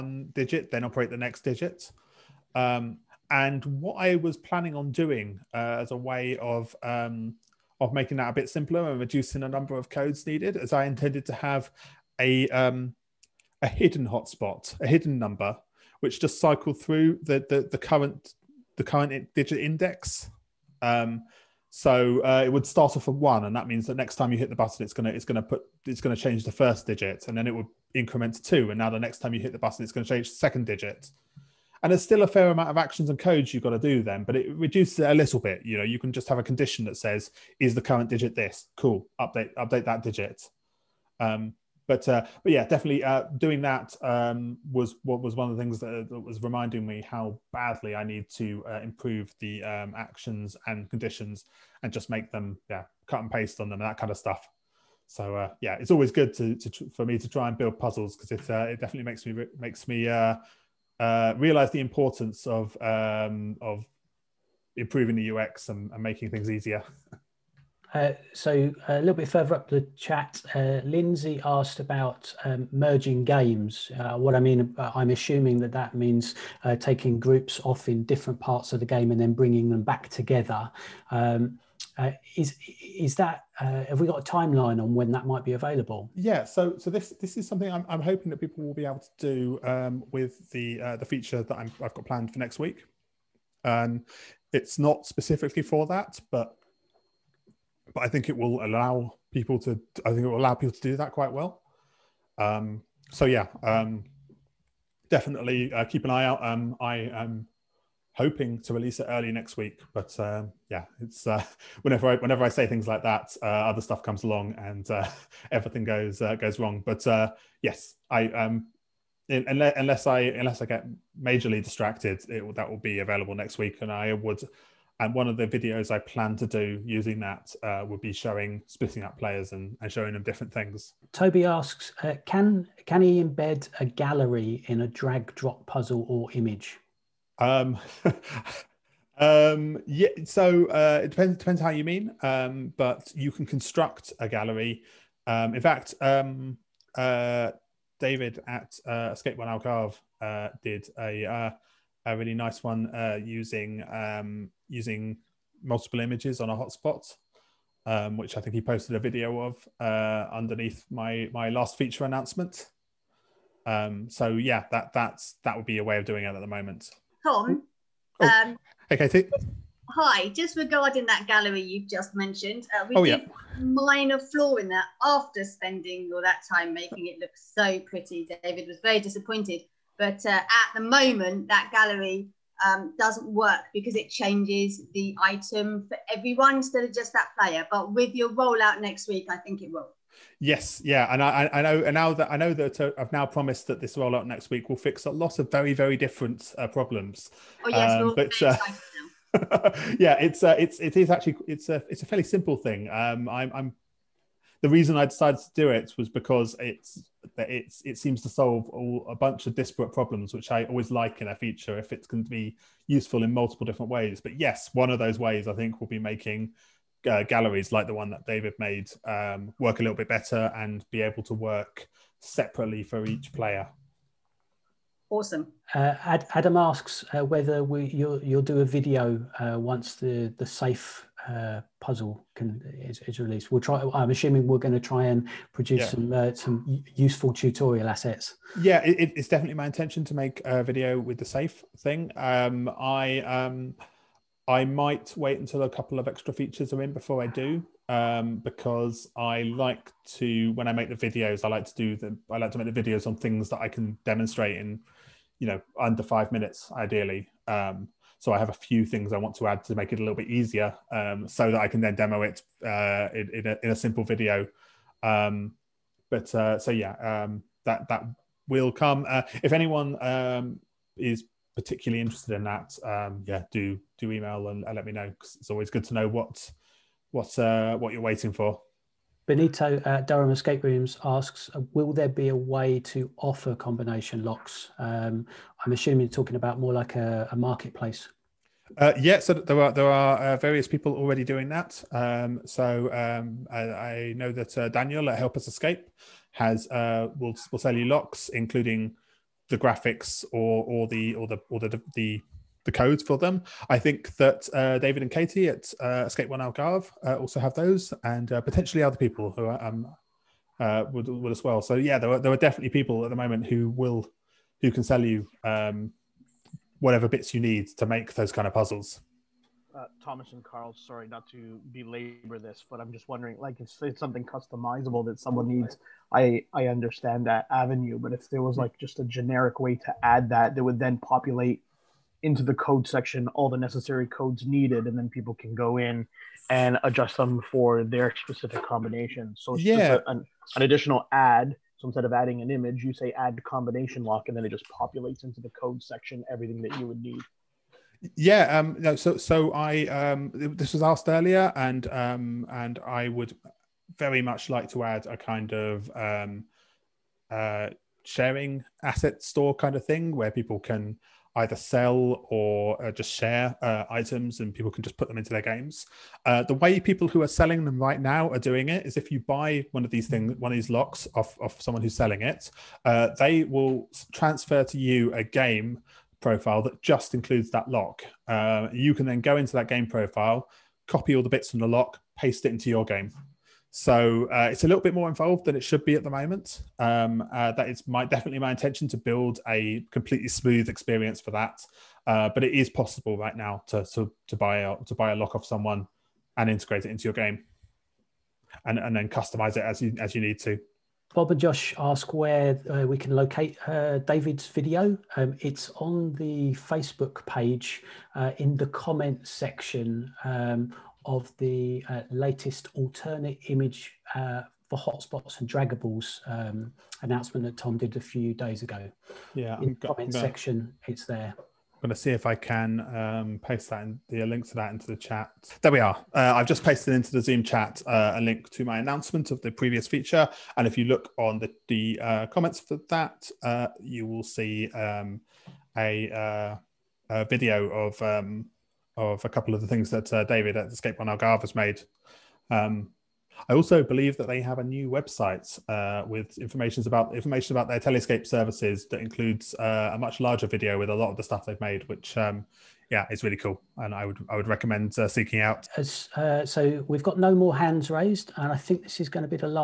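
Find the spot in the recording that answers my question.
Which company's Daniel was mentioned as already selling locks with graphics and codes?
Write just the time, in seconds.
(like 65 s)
295 s.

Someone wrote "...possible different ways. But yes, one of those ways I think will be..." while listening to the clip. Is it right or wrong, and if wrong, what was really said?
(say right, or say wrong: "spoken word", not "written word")
wrong: "multiple", not "possible".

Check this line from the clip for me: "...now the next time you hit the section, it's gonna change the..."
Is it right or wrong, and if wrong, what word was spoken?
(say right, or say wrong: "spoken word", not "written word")
wrong: "button", not "section".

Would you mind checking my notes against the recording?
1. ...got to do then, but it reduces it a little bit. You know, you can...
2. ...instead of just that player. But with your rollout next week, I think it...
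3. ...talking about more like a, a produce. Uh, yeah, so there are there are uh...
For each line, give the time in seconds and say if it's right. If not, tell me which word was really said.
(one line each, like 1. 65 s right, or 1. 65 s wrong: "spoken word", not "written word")
1. 33 s right
2. 186 s right
3. 286 s wrong: "marketplace", not "produce".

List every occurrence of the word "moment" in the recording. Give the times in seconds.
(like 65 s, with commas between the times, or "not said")
166 s, 180 s, 313 s, 386 s.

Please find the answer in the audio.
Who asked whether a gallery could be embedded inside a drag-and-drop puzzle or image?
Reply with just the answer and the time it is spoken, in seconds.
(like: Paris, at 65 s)
Toby, at 131 s.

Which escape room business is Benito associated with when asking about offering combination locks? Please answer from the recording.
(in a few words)
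Durham Escape Rooms.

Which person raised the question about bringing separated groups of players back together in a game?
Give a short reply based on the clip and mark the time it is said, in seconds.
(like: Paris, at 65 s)
Lindsay, at 70 s.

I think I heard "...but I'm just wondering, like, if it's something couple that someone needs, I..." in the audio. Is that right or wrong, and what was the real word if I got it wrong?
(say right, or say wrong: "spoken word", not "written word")
wrong: "customizable", not "couple".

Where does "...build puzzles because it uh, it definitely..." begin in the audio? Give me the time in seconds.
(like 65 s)
57 s.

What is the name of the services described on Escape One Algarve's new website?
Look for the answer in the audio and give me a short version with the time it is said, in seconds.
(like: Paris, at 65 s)
Telescape, at 447 s.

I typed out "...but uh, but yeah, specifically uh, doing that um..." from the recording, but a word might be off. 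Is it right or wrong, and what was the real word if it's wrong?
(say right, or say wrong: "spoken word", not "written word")
wrong: "definitely", not "specifically".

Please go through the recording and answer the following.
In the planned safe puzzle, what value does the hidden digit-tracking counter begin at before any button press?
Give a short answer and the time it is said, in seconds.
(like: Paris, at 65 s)
1, at 22 s.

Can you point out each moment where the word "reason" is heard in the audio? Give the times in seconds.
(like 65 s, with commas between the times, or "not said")
204 s.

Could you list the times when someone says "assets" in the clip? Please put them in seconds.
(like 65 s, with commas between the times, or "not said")
237 s, 358 s.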